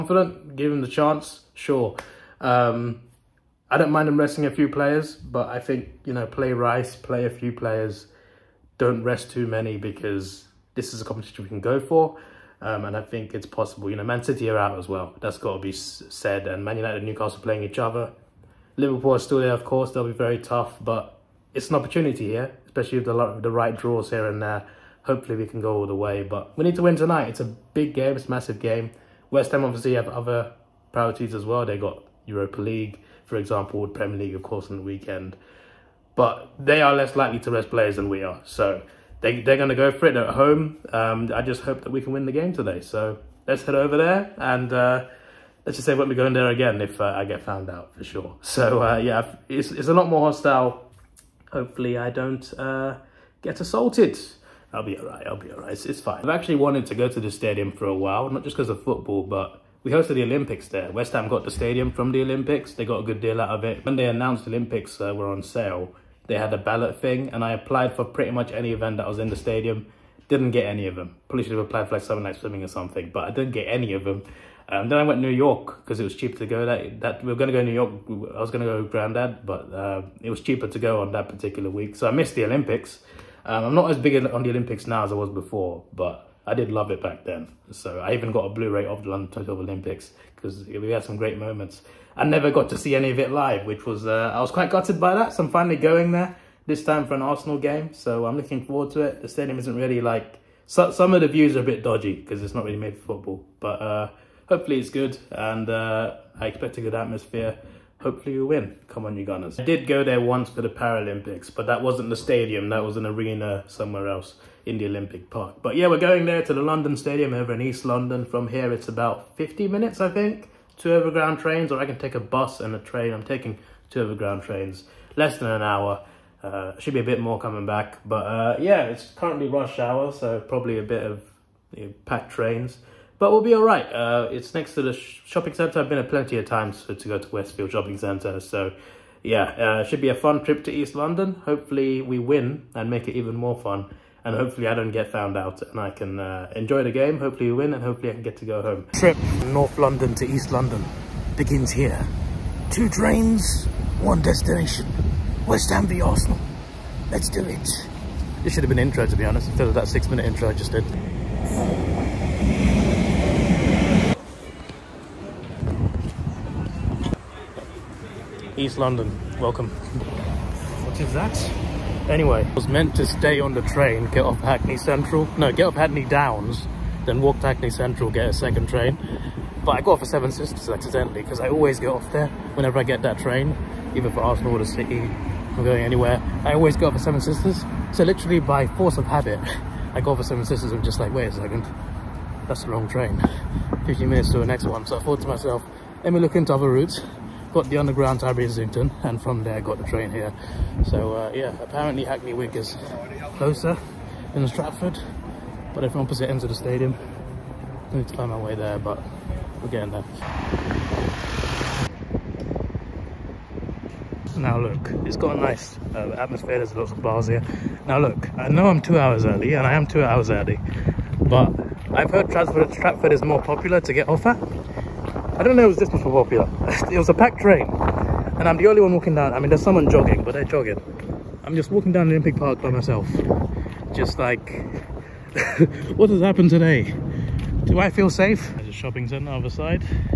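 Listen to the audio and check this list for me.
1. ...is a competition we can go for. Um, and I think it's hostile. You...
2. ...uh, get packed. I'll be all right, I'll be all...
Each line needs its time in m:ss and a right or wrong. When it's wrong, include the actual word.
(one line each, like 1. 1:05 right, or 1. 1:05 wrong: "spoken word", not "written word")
1. 0:10 wrong: "possible", not "hostile"
2. 0:52 wrong: "assaulted", not "packed".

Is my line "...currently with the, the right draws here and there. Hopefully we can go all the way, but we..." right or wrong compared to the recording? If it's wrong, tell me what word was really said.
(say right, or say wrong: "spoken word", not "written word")
wrong: "especially", not "currently".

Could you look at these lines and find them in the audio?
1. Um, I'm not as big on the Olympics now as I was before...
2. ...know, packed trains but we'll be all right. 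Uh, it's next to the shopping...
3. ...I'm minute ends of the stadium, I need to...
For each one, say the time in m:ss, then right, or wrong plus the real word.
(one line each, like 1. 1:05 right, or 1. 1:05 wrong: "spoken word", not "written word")
1. 1:23 right
2. 2:11 right
3. 3:25 wrong: "opposite", not "minute".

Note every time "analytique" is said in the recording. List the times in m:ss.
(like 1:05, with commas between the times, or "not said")
not said.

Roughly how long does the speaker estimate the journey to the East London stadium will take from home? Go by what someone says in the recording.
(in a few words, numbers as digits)
50 minutes.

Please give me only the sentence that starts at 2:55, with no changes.
No, get off Hackney Downs, then walk to Hackney Central, get a second train.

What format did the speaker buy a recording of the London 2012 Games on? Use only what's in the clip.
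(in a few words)
Blu-ray.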